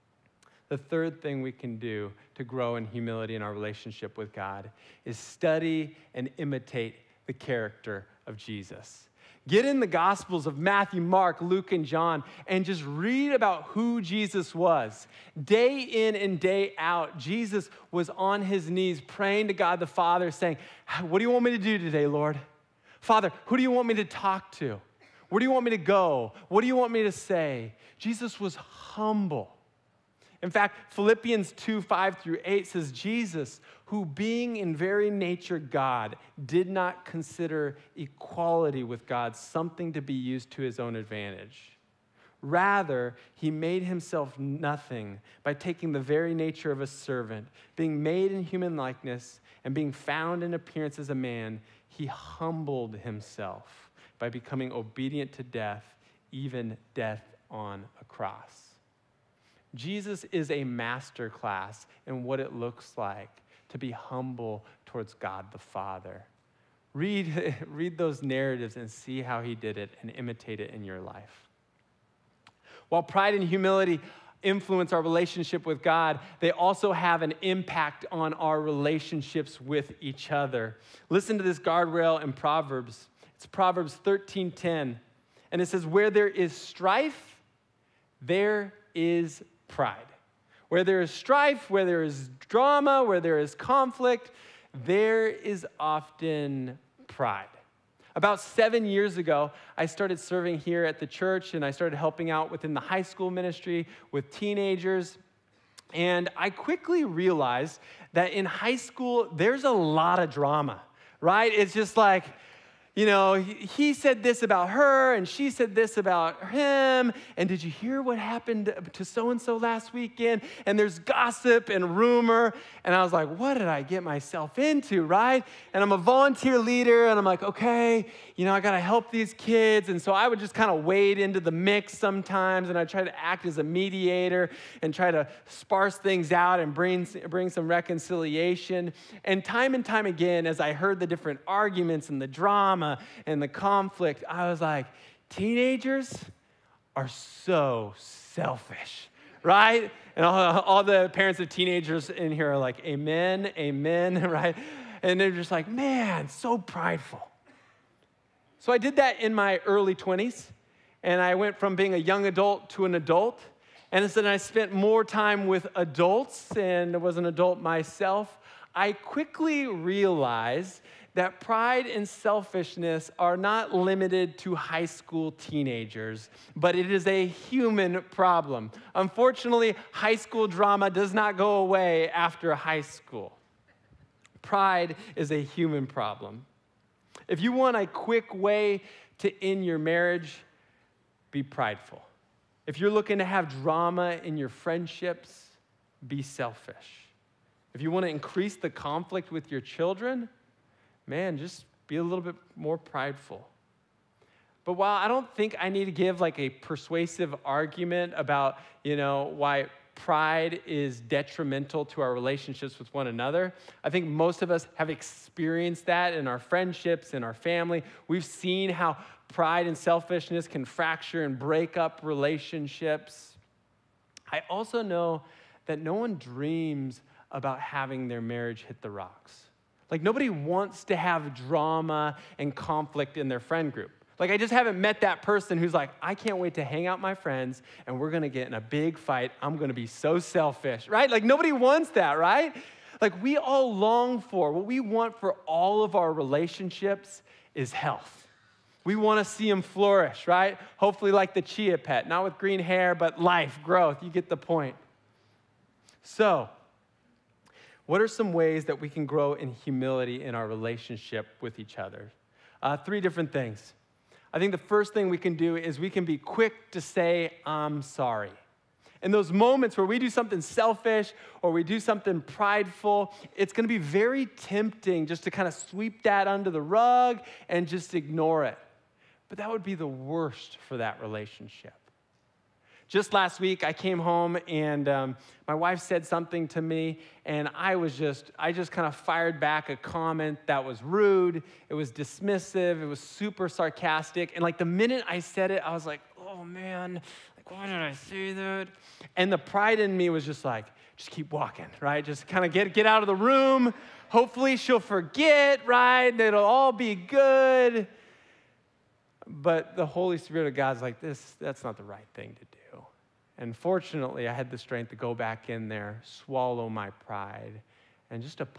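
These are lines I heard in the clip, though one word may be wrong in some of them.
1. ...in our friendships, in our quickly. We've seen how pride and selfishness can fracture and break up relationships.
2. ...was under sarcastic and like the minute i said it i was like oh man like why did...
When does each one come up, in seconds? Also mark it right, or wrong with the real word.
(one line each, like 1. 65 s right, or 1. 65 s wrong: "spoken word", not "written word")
1. 216 s wrong: "family", not "quickly"
2. 292 s wrong: "super", not "under".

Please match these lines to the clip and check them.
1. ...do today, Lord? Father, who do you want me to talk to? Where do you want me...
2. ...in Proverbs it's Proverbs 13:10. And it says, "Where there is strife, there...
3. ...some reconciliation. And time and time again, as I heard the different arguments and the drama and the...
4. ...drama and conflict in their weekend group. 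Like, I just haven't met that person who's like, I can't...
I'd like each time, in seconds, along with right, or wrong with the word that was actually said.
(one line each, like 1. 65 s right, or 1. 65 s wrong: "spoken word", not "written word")
1. 21 s right
2. 82 s right
3. 137 s right
4. 231 s wrong: "friend", not "weekend".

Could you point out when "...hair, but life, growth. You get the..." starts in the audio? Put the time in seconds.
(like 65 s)
252 s.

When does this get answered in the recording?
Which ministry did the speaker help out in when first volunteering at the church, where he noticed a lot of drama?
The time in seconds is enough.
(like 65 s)
102 s.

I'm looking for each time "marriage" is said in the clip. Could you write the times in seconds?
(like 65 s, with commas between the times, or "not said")
189 s, 228 s.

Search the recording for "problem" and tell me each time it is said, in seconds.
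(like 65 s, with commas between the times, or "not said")
178 s, 185 s.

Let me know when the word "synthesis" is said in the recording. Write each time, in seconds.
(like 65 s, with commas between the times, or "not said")
not said.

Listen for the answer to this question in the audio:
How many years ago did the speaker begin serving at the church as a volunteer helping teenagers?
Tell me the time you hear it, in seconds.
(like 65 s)
98 s.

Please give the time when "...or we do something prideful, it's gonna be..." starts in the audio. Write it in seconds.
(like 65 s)
271 s.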